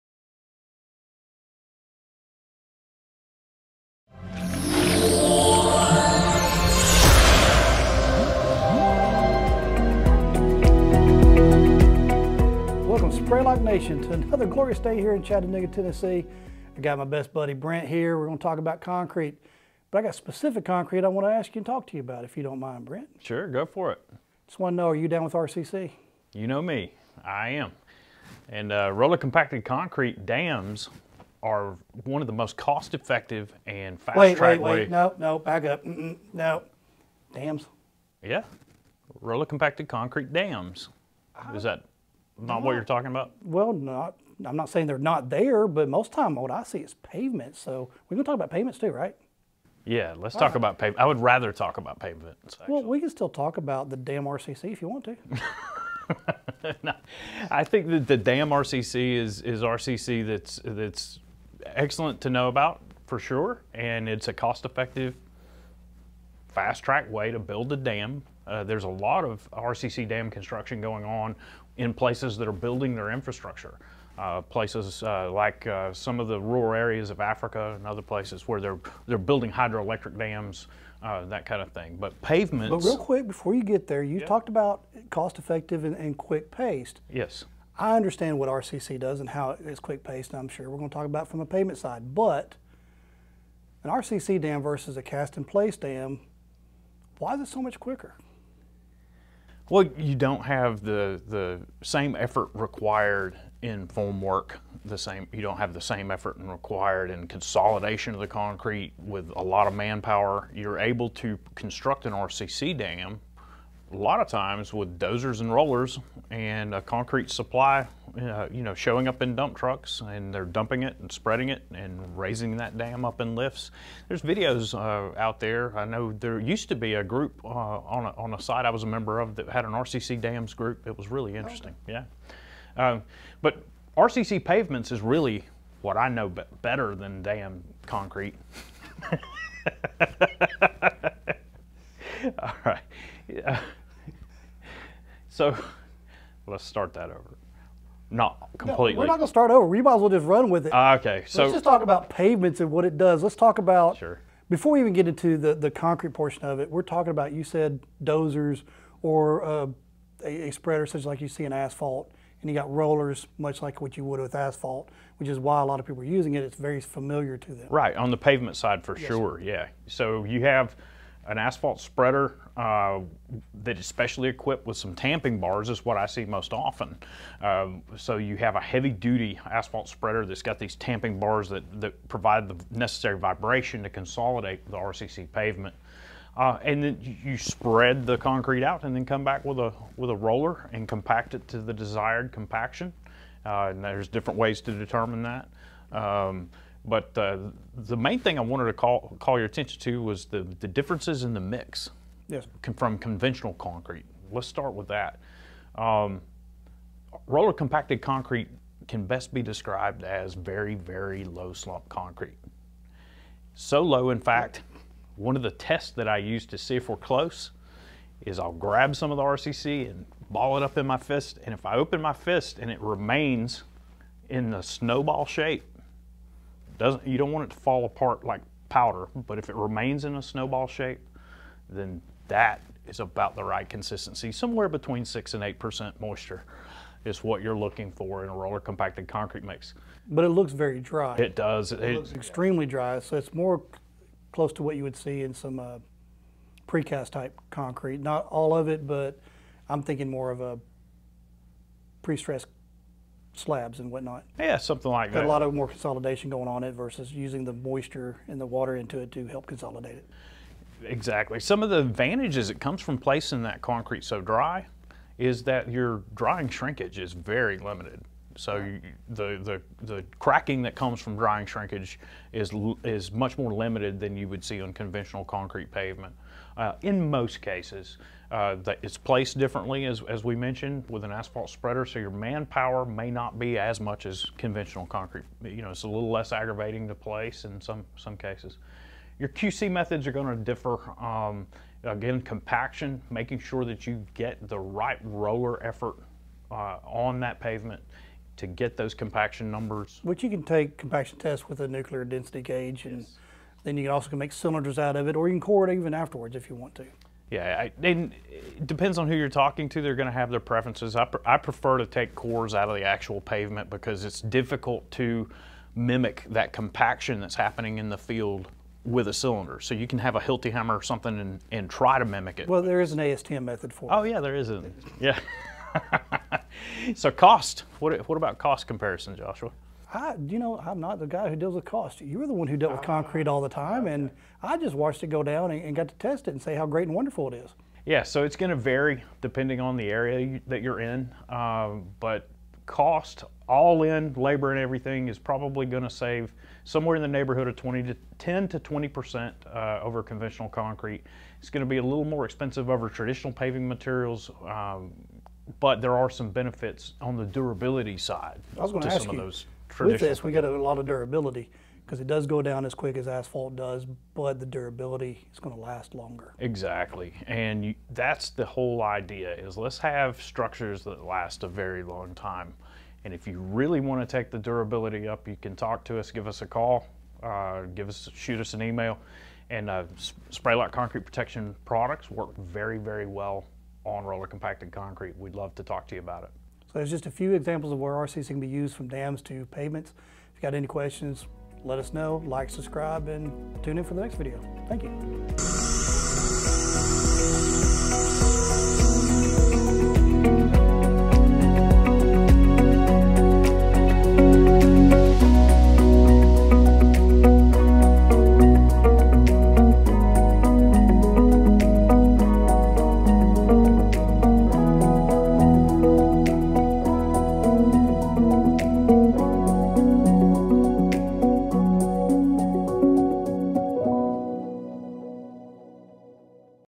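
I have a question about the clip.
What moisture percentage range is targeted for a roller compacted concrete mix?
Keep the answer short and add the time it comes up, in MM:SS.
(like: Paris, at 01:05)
6 to 8%, at 03:54.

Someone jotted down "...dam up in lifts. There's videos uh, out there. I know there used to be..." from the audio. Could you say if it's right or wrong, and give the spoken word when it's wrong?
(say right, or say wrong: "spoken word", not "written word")
right.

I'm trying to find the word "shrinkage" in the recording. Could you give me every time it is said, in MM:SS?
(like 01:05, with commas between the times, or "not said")
04:26, 04:31.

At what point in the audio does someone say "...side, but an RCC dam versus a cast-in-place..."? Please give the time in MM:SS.
01:31.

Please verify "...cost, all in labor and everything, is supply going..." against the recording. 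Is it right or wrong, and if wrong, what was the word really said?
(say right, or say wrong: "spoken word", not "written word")
wrong: "probably", not "supply".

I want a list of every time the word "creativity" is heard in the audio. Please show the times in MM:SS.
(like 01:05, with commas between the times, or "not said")
not said.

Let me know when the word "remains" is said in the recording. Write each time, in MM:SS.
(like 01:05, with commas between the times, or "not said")
03:42, 03:49.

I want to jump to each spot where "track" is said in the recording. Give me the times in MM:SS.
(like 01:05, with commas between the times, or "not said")
00:34, 01:06.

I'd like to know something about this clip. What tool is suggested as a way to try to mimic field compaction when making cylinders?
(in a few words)
Hilti hammer.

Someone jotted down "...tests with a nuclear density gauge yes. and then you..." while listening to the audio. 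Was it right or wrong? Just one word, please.
right.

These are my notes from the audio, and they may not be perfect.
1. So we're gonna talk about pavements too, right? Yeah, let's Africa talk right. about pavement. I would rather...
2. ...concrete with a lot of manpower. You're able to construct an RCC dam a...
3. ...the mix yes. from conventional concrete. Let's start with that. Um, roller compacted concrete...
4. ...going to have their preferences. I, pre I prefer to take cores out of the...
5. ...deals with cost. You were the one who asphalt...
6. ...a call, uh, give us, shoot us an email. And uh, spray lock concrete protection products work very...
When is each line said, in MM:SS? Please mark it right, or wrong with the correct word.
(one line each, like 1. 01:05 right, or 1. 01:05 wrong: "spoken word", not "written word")
1. 00:47 wrong: "All", not "Africa"
2. 01:48 right
3. 03:21 right
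4. 05:09 right
5. 05:31 wrong: "dealt", not "asphalt"
6. 06:16 right.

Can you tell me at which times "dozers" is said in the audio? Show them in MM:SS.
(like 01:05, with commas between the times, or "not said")
01:54, 02:38.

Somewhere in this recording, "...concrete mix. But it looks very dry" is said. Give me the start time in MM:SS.
03:59.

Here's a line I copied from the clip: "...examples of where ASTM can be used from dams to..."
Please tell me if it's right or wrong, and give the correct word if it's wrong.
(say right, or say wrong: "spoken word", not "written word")
wrong: "RCs", not "ASTM".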